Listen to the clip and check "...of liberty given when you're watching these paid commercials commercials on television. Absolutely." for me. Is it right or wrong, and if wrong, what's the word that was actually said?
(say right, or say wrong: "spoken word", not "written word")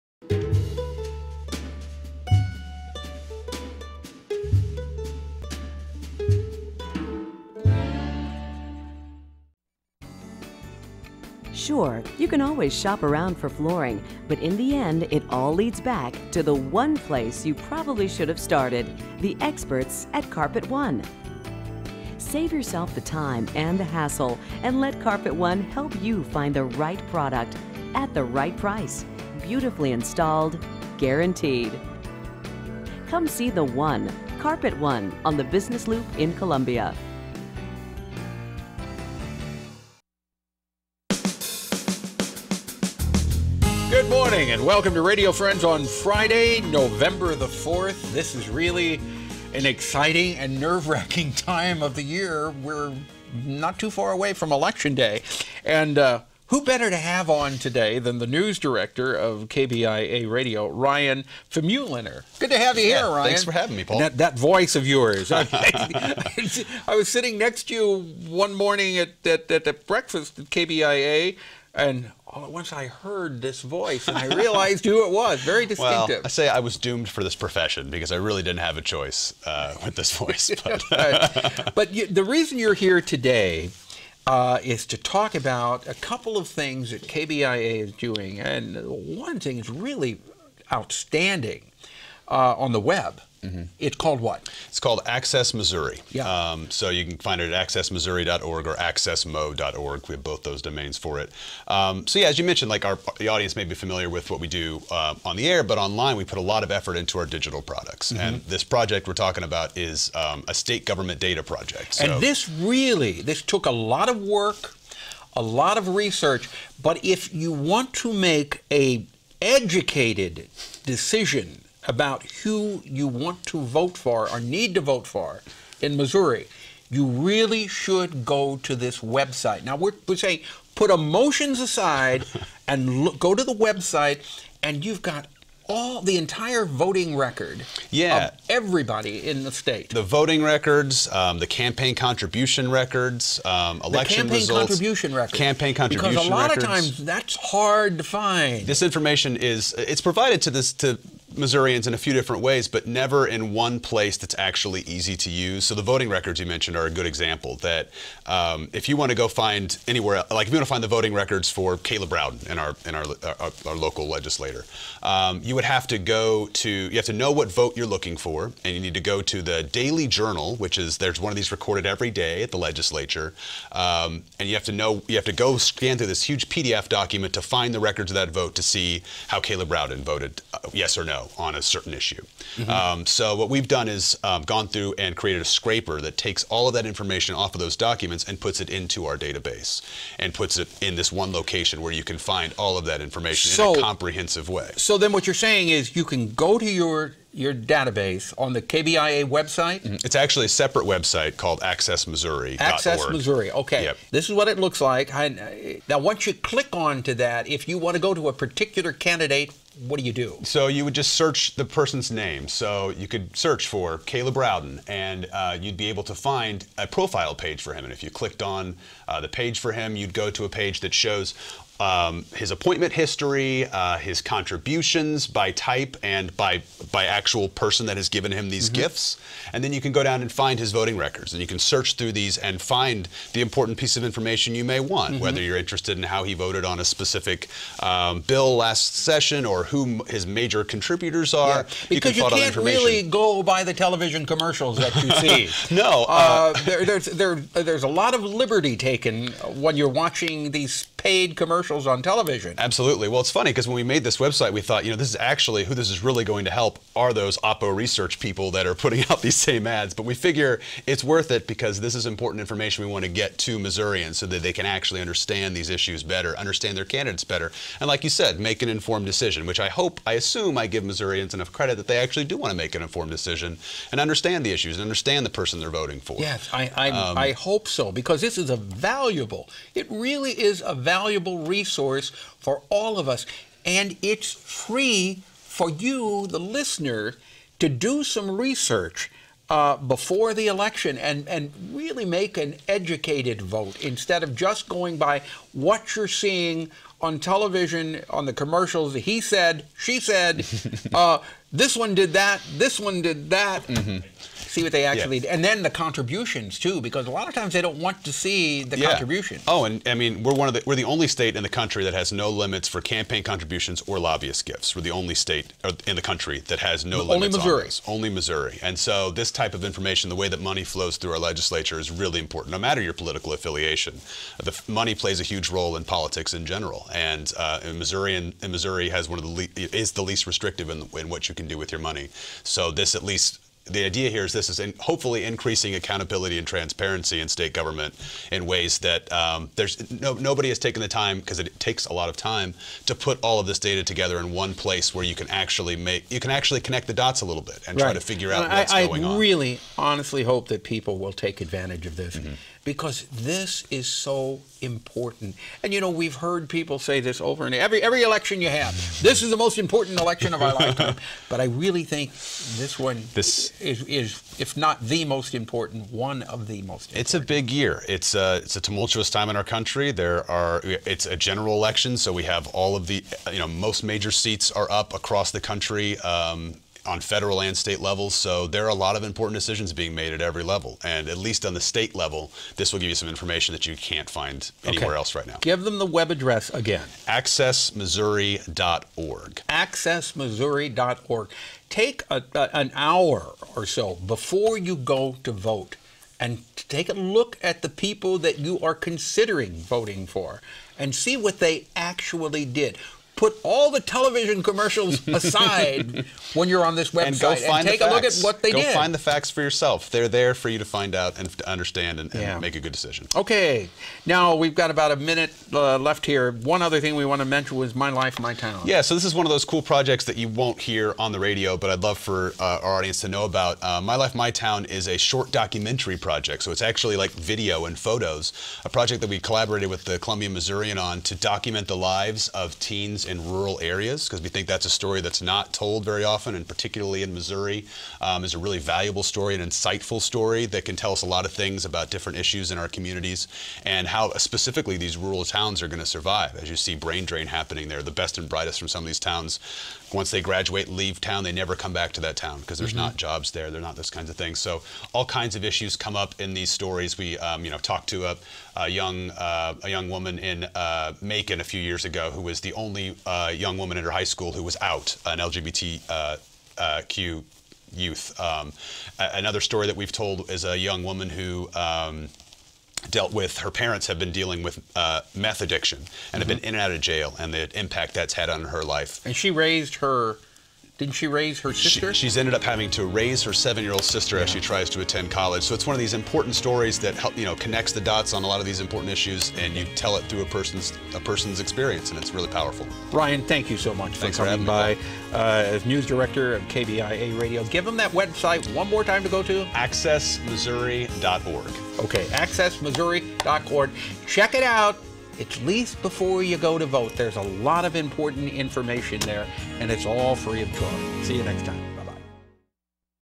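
wrong: "taken", not "given".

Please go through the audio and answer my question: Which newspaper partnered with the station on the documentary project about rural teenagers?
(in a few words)
Columbia Missourian.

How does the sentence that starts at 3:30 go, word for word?
So you would just search the person's name.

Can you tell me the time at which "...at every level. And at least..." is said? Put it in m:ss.
6:20.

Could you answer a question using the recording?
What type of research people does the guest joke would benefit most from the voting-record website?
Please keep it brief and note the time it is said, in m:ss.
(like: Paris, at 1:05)
Oppo research, at 4:17.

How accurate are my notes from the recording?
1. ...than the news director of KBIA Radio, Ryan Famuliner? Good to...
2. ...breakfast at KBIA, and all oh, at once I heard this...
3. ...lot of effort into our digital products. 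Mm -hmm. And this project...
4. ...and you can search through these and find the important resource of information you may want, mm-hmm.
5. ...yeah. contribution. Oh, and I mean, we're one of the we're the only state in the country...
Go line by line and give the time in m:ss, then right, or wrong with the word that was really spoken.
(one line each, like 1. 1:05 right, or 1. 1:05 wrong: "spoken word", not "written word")
1. 0:57 right
2. 1:09 right
3. 1:46 right
4. 3:51 wrong: "piece", not "resource"
5. 5:08 right.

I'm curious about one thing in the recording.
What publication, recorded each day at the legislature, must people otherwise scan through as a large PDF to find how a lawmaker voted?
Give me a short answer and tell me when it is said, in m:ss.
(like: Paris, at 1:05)
Daily Journal, at 2:49.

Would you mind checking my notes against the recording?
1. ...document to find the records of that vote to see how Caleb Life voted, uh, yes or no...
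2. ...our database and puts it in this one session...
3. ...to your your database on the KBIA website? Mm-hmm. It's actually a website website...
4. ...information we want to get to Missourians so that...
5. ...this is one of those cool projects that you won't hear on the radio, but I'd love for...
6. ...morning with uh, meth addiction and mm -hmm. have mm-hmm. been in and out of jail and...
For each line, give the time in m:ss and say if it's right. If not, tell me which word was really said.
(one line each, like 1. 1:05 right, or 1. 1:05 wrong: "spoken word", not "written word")
1. 2:56 wrong: "Rowden", not "Life"
2. 3:09 wrong: "location", not "session"
3. 3:16 wrong: "separate", not "website"
4. 4:22 right
5. 6:58 right
6. 7:54 wrong: "dealing", not "morning".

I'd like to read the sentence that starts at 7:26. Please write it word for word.
As you see, brain drain happening there.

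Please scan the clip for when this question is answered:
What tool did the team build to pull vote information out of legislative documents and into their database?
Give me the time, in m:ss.
3:05.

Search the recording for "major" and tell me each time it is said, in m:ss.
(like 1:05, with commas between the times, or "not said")
4:00, 6:13.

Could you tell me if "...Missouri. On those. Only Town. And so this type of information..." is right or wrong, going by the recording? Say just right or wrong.
wrong.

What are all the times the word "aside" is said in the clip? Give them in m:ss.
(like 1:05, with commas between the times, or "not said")
2:11, 6:45.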